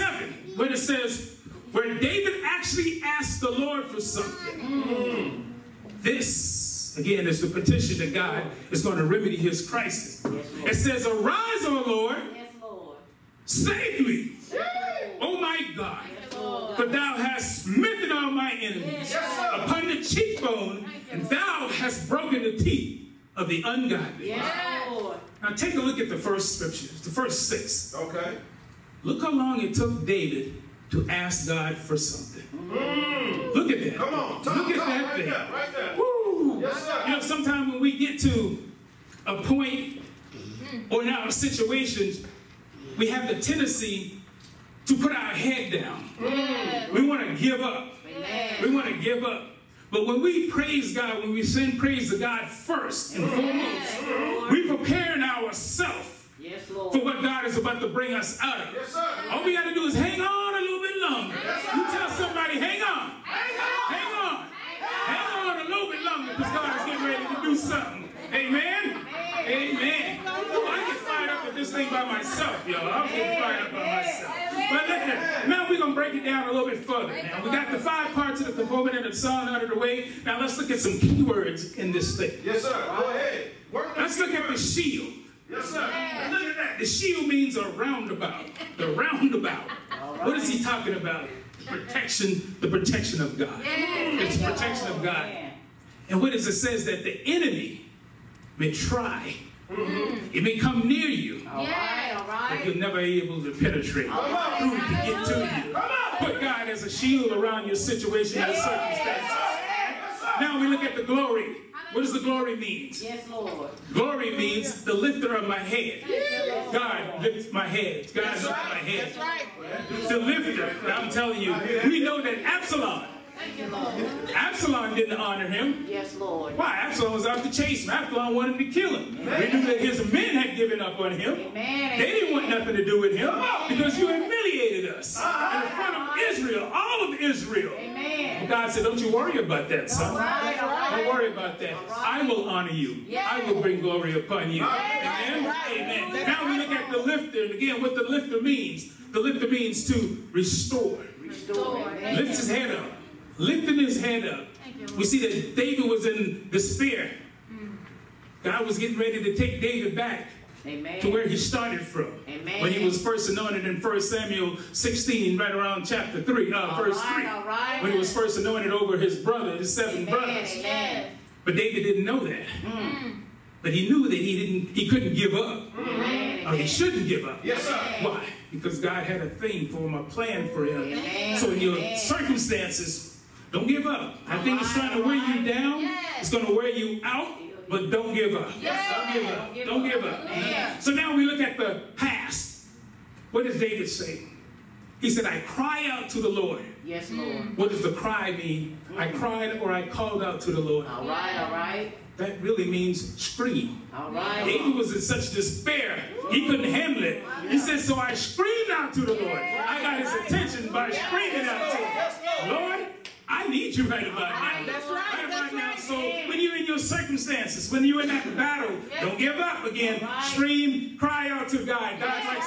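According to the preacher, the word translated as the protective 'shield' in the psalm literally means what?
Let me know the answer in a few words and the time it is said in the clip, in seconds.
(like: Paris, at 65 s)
A roundabout, at 87 s.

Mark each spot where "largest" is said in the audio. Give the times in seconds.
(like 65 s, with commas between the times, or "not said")
not said.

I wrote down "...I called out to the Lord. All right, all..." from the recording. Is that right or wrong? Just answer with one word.
right.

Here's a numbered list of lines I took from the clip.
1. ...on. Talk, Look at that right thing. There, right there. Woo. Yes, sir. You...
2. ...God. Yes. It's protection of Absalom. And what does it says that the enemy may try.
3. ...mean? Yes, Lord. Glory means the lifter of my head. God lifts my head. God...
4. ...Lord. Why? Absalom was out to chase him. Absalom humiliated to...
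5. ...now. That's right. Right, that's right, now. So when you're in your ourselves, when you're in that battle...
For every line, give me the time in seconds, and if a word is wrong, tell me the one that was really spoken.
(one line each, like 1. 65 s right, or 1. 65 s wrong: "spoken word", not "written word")
1. 34 s right
2. 93 s wrong: "God", not "Absalom"
3. 112 s right
4. 126 s wrong: "wanted", not "humiliated"
5. 214 s wrong: "circumstances", not "ourselves".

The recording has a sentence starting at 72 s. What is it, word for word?
I'm getting fired up by myself.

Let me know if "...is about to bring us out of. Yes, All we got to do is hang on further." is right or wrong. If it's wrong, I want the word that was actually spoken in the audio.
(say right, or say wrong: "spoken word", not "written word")
wrong: "longer", not "further".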